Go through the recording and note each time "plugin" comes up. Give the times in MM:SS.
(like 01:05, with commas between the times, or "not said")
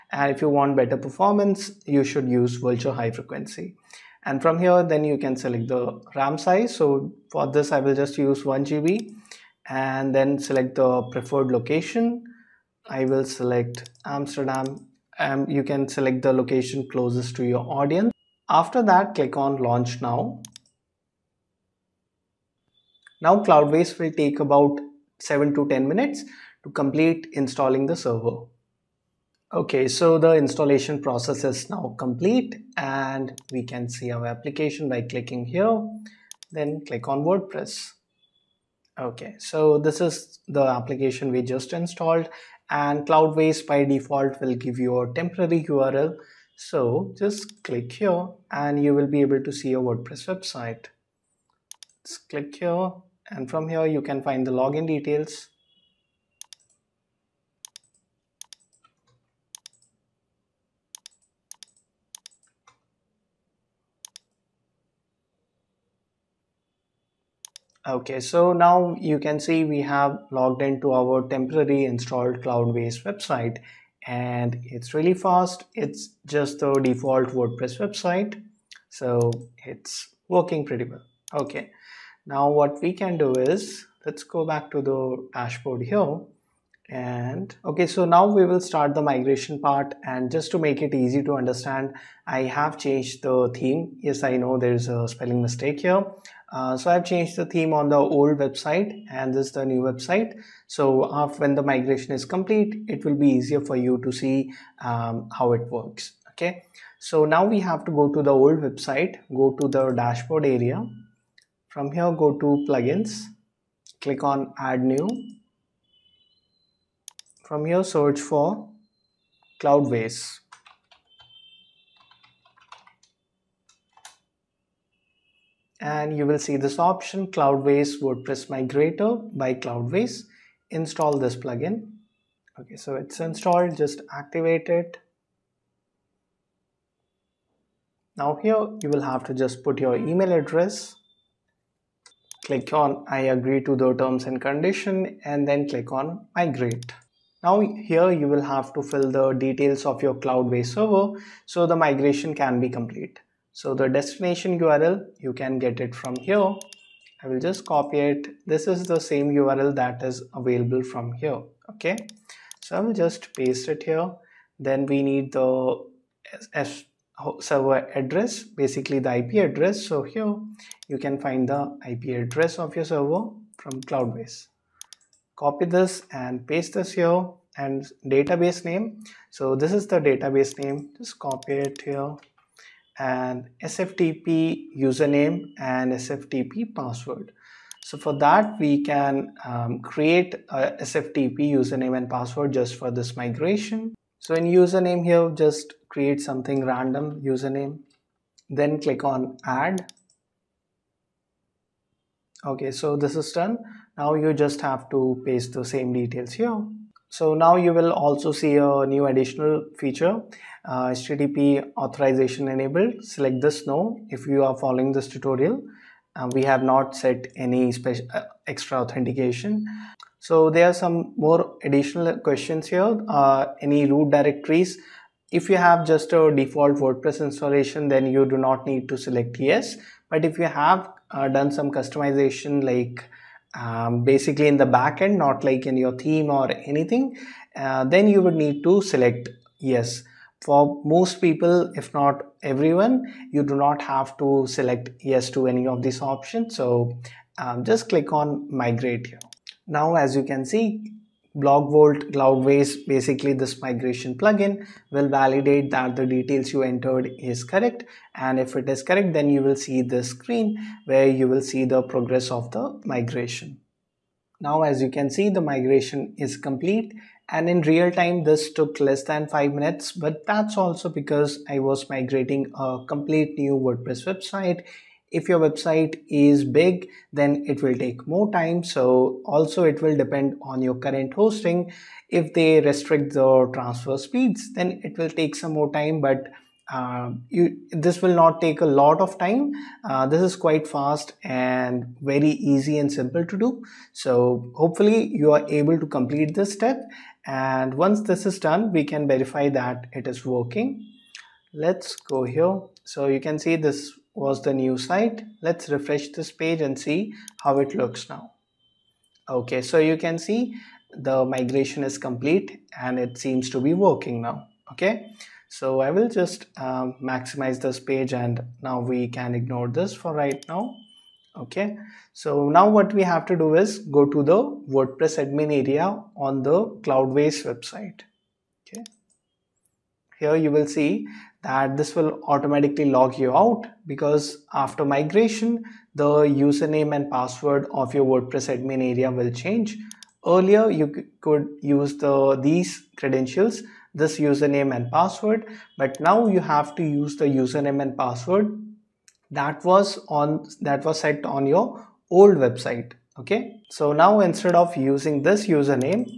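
01:52, 02:11, 04:14.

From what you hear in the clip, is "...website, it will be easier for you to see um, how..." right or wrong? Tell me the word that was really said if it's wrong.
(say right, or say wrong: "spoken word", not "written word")
wrong: "complete", not "website".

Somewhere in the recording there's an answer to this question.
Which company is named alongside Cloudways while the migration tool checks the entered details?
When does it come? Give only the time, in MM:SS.
04:11.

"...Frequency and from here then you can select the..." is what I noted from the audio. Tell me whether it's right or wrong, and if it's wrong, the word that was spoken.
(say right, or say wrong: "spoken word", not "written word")
right.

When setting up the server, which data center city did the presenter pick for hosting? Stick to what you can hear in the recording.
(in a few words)
Amsterdam.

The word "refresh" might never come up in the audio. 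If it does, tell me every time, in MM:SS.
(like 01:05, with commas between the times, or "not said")
05:05.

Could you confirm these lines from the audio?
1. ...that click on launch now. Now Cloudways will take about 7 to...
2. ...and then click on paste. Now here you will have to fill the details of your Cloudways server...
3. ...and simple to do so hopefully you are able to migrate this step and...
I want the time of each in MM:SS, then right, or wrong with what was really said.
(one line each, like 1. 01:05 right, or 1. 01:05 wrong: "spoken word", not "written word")
1. 00:18 right
2. 02:25 wrong: "migrate", not "paste"
3. 04:52 wrong: "complete", not "migrate".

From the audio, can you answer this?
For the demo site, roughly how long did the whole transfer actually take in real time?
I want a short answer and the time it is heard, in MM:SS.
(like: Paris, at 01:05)
less than 5 minutes, at 04:28.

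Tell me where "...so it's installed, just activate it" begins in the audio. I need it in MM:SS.
02:12.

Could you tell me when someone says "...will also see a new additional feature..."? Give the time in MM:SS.
03:27.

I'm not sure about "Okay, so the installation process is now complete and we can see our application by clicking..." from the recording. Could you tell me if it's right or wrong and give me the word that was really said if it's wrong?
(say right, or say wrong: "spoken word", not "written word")
right.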